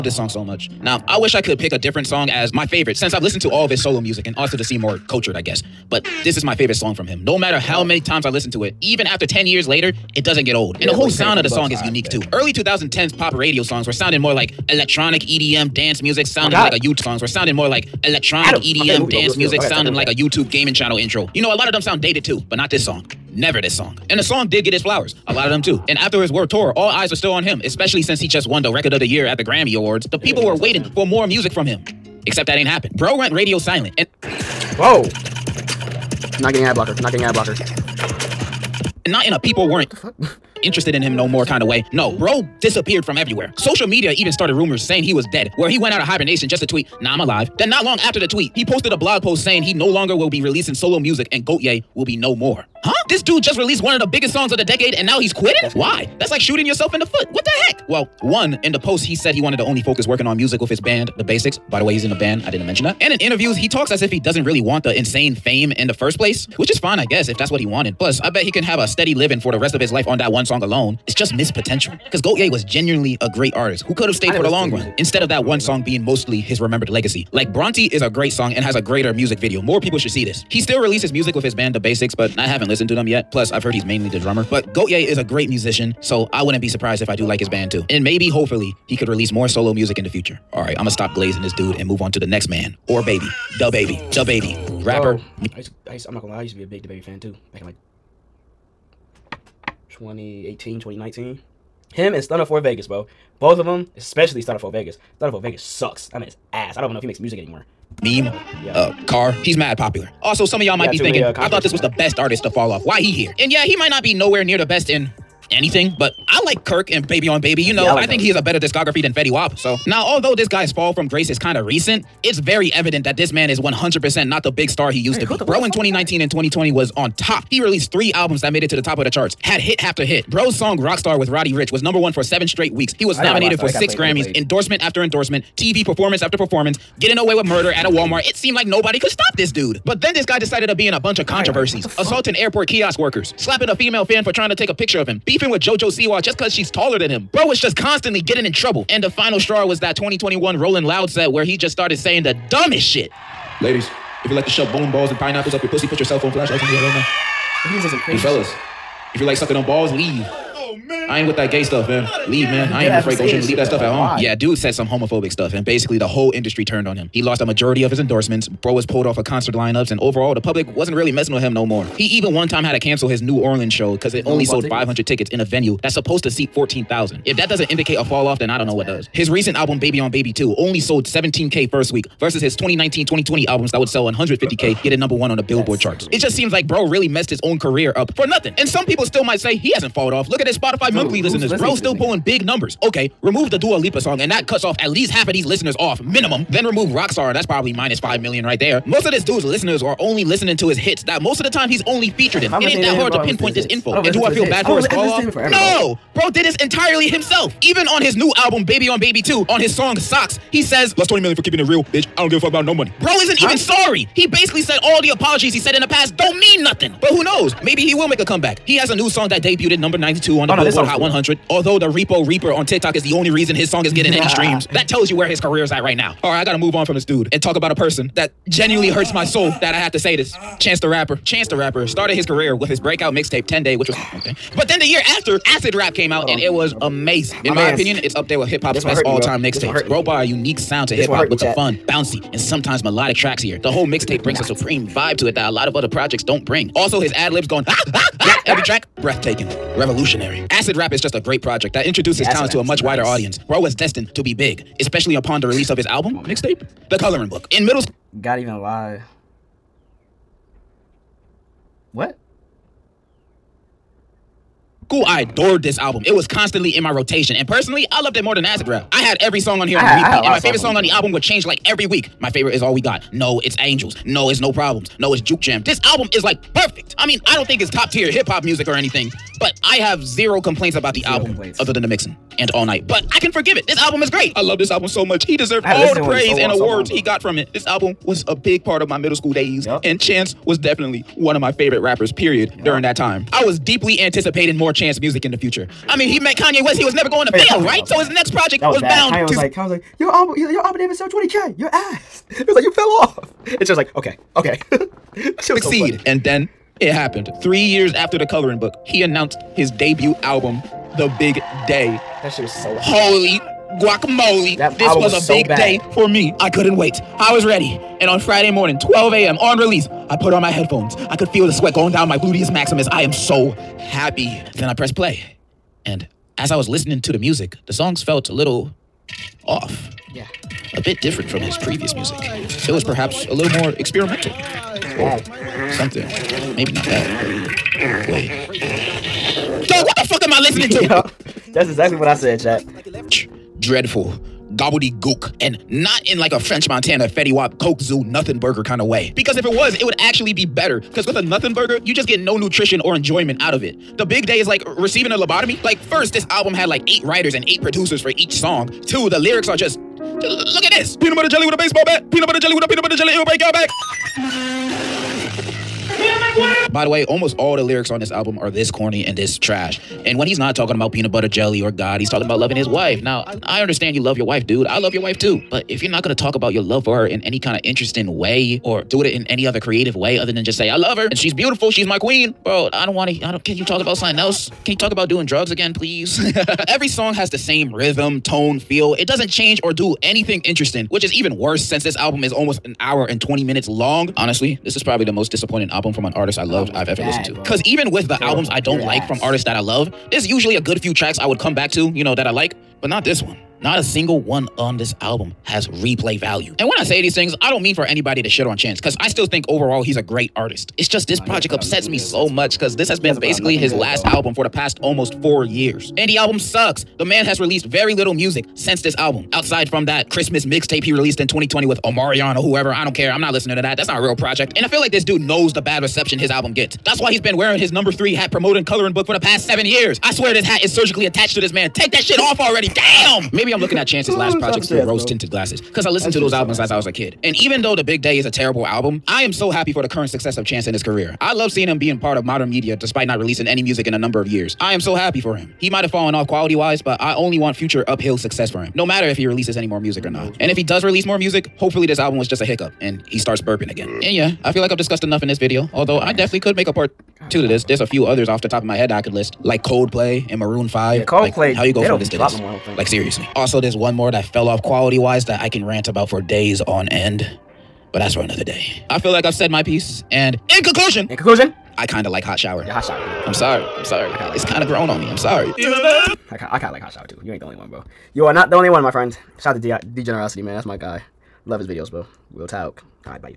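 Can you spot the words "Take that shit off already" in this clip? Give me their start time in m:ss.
7:11.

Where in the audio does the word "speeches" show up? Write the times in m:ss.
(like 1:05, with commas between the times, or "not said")
not said.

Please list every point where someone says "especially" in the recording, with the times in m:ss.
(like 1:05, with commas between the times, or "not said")
0:27, 1:43, 4:14.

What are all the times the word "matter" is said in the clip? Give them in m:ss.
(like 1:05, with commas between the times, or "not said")
0:07, 7:28.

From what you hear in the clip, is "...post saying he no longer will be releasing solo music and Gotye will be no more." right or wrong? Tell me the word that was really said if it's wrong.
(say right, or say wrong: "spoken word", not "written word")
right.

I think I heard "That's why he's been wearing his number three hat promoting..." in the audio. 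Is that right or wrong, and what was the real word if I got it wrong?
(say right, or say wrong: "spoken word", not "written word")
right.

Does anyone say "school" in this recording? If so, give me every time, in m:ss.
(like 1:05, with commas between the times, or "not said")
4:17, 4:49.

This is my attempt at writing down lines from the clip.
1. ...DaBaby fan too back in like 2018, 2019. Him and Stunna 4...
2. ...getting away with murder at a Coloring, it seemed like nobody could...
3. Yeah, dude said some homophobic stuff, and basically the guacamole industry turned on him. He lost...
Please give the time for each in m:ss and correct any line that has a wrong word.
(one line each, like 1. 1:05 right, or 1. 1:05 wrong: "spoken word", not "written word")
1. 1:36 right
2. 2:16 wrong: "Walmart", not "Coloring"
3. 2:44 wrong: "whole", not "guacamole".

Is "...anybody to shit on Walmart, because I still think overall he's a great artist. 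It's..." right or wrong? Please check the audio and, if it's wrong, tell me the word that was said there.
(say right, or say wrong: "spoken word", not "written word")
wrong: "Chance", not "Walmart".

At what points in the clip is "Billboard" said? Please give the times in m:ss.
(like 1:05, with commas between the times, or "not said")
3:05, 3:40.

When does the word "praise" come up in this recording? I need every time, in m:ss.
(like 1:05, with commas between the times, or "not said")
4:46.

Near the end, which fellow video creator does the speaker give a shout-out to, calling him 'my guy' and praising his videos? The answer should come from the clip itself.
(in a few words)
Degenerocity.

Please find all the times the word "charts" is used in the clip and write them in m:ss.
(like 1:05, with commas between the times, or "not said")
2:09, 3:05.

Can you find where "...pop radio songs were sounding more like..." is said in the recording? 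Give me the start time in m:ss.
0:13.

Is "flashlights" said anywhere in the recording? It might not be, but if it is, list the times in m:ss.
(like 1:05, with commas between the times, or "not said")
2:36.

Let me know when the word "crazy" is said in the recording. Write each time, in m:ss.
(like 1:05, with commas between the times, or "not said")
2:38, 3:06.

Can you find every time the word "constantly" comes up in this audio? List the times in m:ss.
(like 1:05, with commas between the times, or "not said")
2:27, 4:26.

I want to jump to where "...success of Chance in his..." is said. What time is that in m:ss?
7:20.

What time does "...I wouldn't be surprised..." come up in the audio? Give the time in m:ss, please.
1:26.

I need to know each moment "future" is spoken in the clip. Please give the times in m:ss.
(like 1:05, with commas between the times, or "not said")
1:30, 4:55, 7:27.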